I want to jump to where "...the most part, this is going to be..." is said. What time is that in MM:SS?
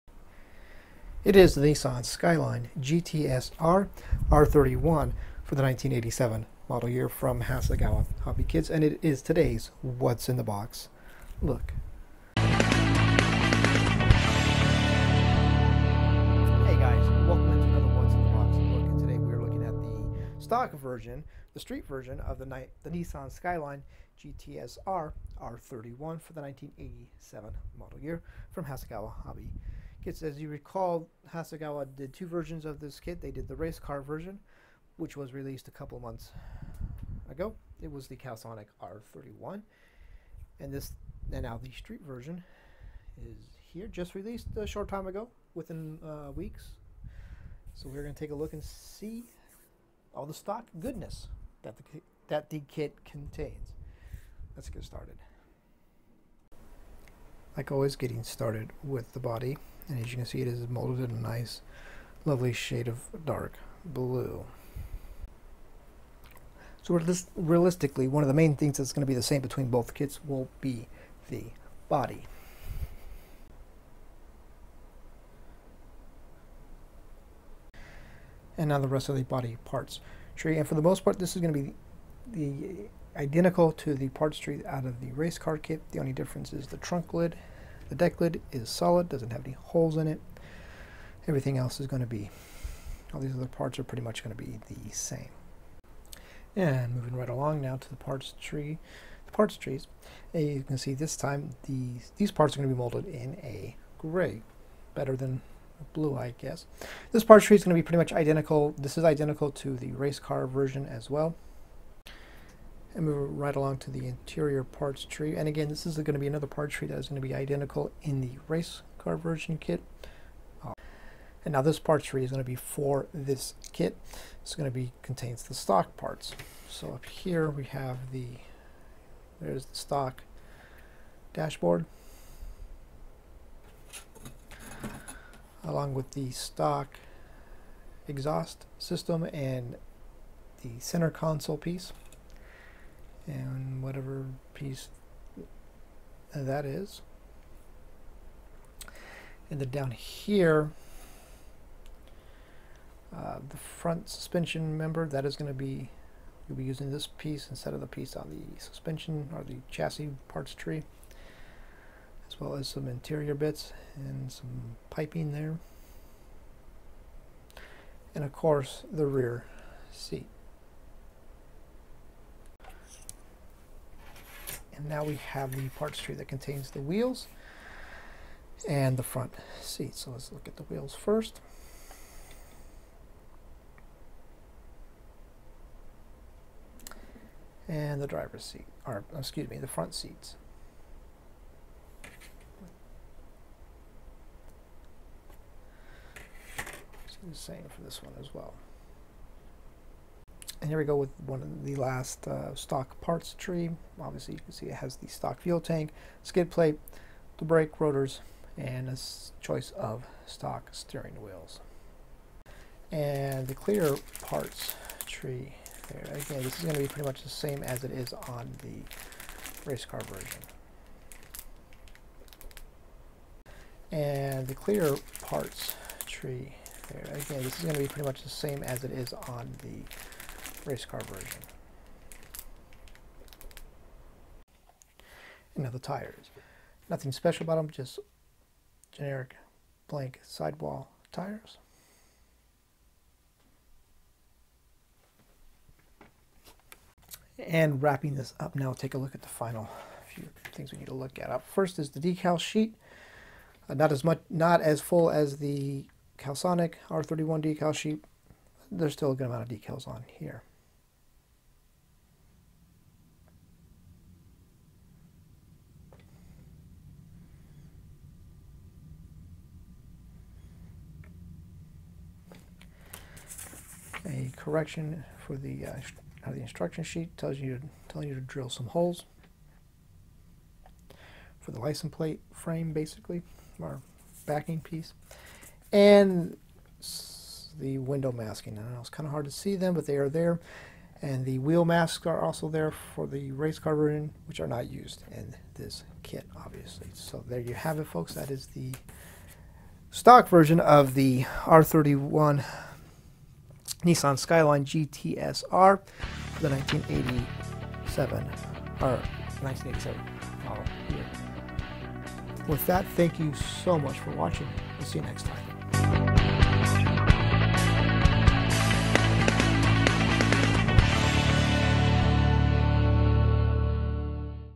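01:20.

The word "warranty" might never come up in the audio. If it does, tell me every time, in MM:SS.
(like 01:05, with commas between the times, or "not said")
not said.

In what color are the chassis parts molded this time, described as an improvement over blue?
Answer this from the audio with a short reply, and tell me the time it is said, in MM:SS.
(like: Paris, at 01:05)
Gray, at 01:43.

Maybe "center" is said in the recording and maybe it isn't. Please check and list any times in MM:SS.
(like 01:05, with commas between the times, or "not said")
02:20.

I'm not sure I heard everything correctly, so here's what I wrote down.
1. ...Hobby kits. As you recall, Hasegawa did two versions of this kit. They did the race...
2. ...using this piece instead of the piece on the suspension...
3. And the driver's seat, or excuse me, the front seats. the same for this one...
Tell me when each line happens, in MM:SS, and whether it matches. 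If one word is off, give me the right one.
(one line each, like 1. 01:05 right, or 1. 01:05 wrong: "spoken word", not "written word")
1. 00:29 right
2. 02:36 right
3. 03:07 right.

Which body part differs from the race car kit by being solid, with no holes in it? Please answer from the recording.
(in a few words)
Trunk lid.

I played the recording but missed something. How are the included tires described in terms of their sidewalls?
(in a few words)
Generic blank sidewall.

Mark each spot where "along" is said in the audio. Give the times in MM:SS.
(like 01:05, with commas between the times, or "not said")
01:37, 01:53, 02:15.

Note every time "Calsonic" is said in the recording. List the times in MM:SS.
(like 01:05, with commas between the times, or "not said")
00:38, 04:16.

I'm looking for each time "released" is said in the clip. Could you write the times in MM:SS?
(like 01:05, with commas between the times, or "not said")
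00:35, 00:44.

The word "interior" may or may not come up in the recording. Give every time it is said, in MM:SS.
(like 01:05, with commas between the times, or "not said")
01:54, 02:42.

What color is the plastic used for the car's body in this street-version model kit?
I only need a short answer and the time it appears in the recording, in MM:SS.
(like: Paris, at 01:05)
Dark blue, at 01:03.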